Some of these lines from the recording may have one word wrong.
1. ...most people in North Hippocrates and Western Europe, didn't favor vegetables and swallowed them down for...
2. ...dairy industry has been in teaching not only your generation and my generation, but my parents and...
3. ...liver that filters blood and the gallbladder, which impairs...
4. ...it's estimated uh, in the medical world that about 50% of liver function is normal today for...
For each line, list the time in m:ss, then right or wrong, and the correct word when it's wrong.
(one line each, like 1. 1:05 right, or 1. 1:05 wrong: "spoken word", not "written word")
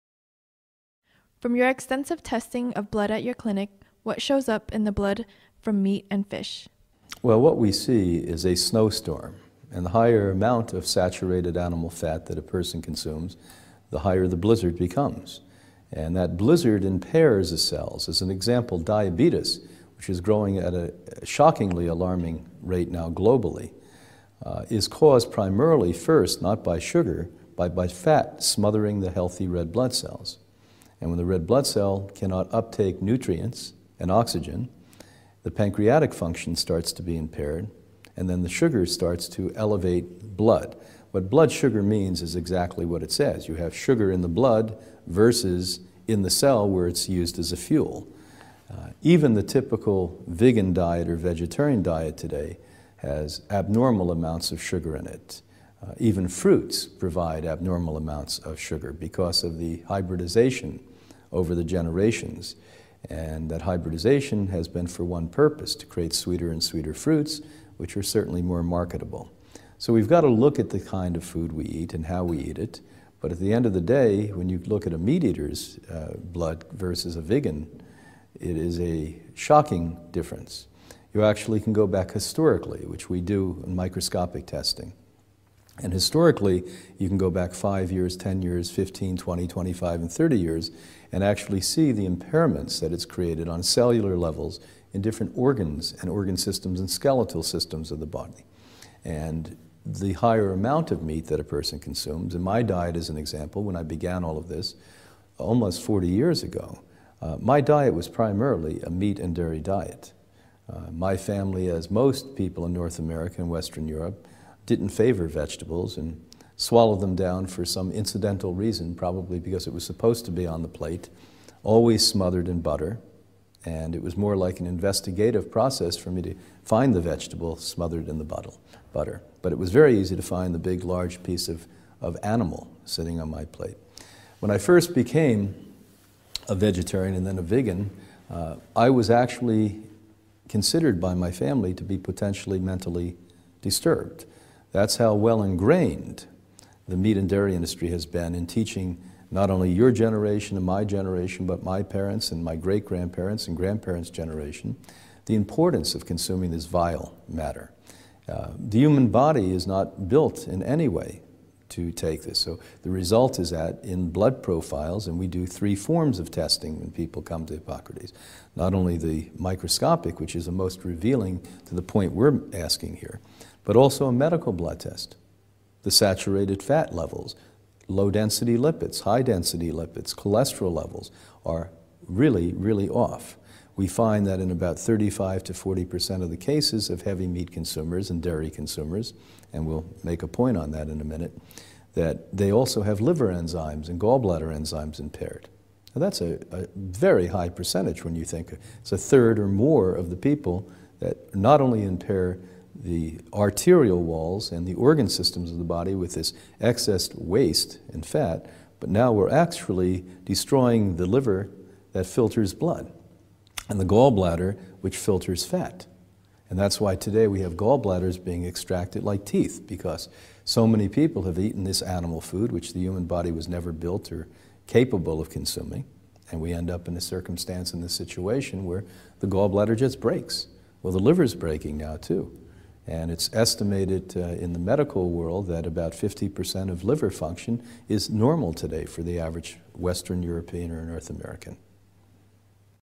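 1. 1:51 wrong: "America", not "Hippocrates"
2. 2:27 right
3. 3:31 wrong: "filters", not "impairs"
4. 3:53 right.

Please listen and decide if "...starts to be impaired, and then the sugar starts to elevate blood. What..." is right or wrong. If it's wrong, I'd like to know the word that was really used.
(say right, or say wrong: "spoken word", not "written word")
right.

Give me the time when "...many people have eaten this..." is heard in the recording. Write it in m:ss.
3:40.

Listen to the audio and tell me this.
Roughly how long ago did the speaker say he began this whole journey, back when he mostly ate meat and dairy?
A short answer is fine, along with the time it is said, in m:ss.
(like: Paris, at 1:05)
almost 40 years, at 1:45.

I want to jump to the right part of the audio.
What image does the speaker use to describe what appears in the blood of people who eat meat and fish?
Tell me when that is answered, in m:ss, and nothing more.
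0:08.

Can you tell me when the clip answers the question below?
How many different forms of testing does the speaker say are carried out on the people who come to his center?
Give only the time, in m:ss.
2:45.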